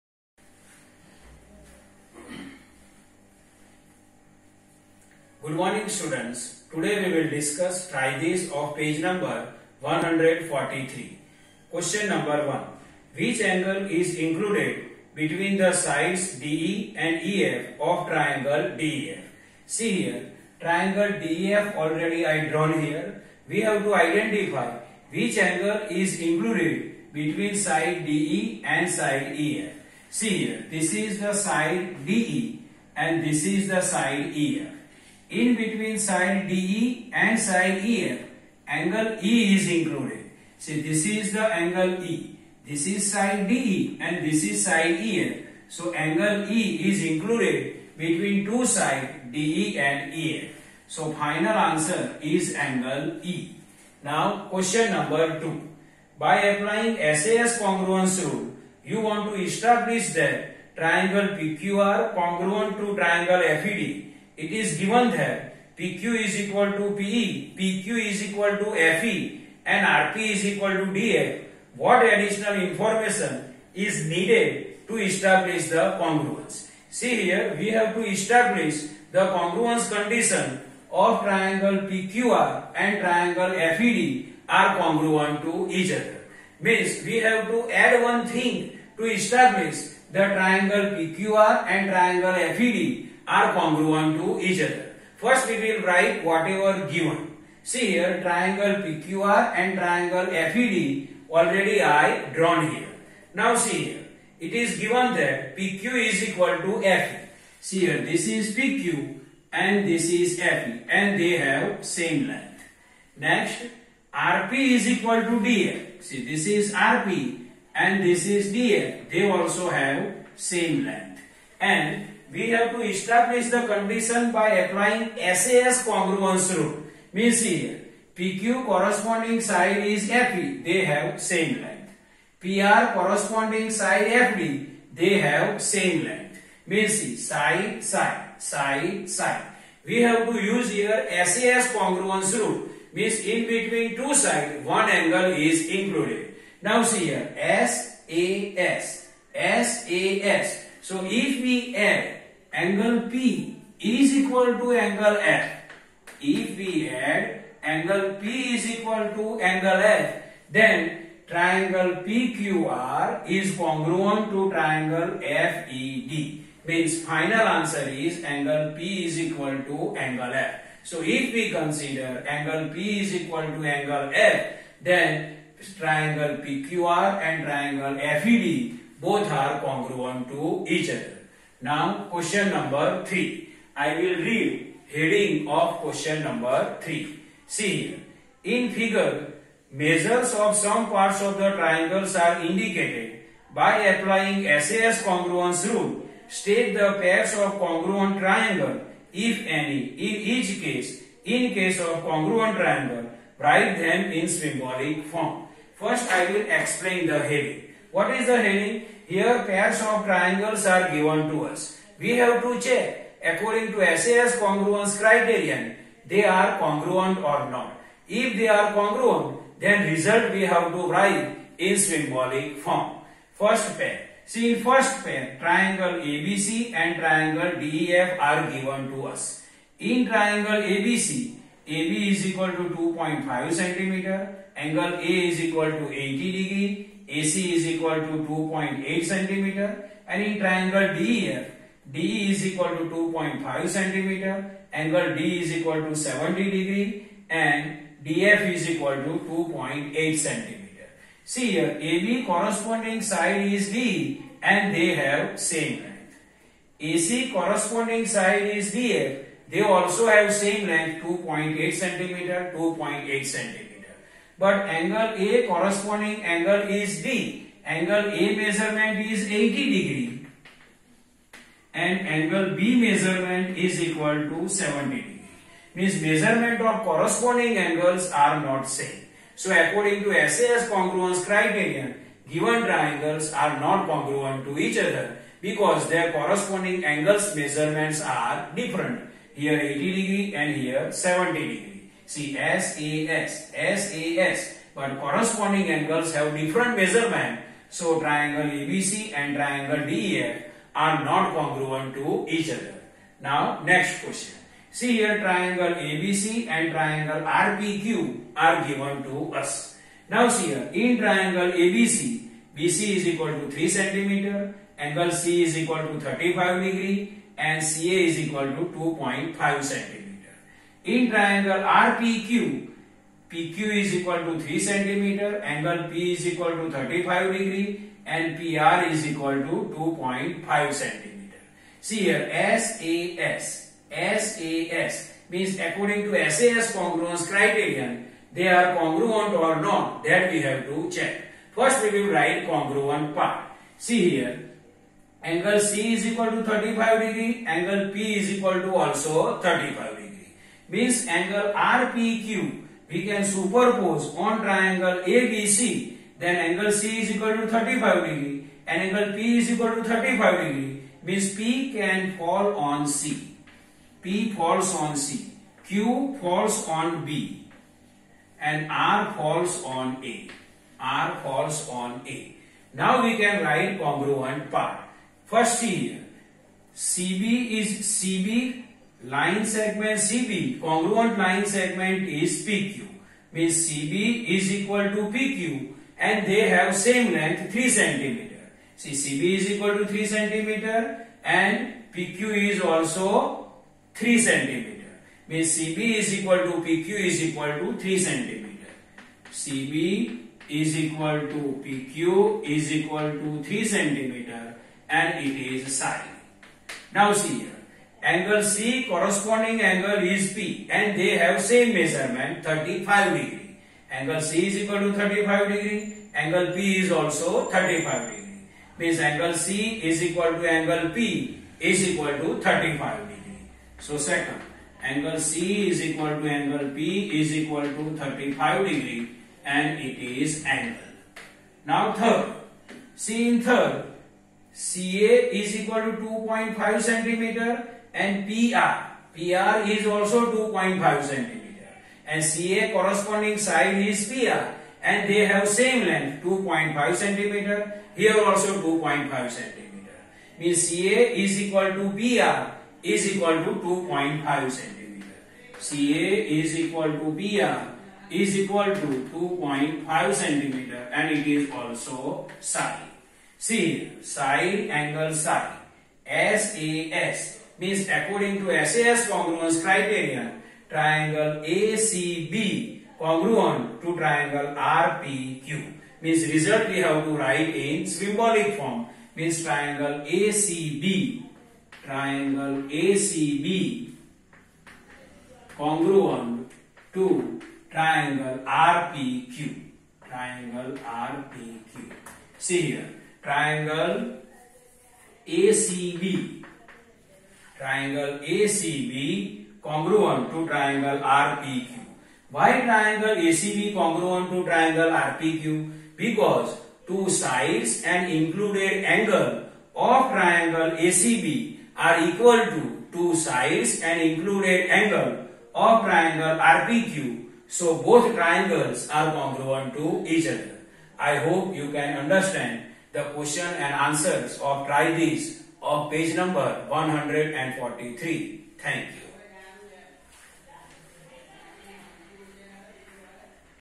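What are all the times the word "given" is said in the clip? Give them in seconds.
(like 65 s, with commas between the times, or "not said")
64 s, 96 s, 104 s, 210 s, 228 s, 282 s, 308 s.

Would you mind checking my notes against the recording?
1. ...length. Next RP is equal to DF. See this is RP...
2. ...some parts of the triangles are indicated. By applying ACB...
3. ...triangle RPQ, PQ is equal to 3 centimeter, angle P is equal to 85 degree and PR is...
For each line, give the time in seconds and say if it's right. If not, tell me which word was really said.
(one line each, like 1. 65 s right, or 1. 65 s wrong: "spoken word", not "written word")
1. 112 s right
2. 190 s wrong: "SAS", not "ACB"
3. 321 s wrong: "35", not "85".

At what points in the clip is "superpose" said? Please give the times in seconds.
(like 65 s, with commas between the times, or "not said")
353 s.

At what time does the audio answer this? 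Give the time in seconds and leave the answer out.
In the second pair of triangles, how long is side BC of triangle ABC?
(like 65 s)
312 s.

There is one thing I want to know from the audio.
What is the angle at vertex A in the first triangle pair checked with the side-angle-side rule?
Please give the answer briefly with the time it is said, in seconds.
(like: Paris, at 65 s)
80 degrees, at 234 s.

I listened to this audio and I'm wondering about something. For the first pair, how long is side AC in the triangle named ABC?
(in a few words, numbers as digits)
2.8 centimeters.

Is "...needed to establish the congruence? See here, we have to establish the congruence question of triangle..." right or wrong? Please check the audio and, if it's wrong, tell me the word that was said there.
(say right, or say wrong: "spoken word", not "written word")
wrong: "condition", not "question".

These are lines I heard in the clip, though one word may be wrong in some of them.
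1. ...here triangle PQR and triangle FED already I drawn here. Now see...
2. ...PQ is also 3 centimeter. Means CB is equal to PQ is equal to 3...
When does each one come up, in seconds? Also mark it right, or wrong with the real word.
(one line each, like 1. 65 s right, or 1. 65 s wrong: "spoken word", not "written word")
1. 97 s right
2. 391 s right.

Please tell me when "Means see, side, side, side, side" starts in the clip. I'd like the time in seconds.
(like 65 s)
136 s.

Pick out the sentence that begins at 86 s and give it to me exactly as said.
Means we have to add one thing to establish the triangle PQR and triangle FED are congruent to each other.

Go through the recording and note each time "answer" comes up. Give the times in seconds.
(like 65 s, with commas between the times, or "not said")
51 s, 167 s, 523 s.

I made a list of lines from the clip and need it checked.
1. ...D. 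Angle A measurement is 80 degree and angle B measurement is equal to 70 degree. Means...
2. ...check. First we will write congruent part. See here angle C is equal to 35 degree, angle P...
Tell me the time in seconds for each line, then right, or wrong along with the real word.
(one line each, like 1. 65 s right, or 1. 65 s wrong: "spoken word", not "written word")
1. 267 s right
2. 340 s right.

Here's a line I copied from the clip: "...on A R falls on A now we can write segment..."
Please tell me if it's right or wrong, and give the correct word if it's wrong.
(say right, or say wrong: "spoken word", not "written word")
wrong: "congruent", not "segment".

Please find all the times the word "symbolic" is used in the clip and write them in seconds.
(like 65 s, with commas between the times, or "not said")
204 s, 221 s, 477 s.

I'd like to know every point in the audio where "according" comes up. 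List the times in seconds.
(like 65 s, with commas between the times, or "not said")
213 s, 279 s, 335 s, 467 s.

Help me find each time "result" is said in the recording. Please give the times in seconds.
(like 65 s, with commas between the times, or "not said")
219 s, 476 s.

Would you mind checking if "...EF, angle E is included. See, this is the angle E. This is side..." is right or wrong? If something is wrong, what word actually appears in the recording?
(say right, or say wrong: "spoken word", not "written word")
right.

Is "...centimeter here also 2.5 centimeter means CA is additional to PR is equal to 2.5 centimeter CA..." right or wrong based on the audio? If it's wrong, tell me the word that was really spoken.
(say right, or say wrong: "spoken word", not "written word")
wrong: "equal", not "additional".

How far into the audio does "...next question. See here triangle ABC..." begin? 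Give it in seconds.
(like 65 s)
303 s.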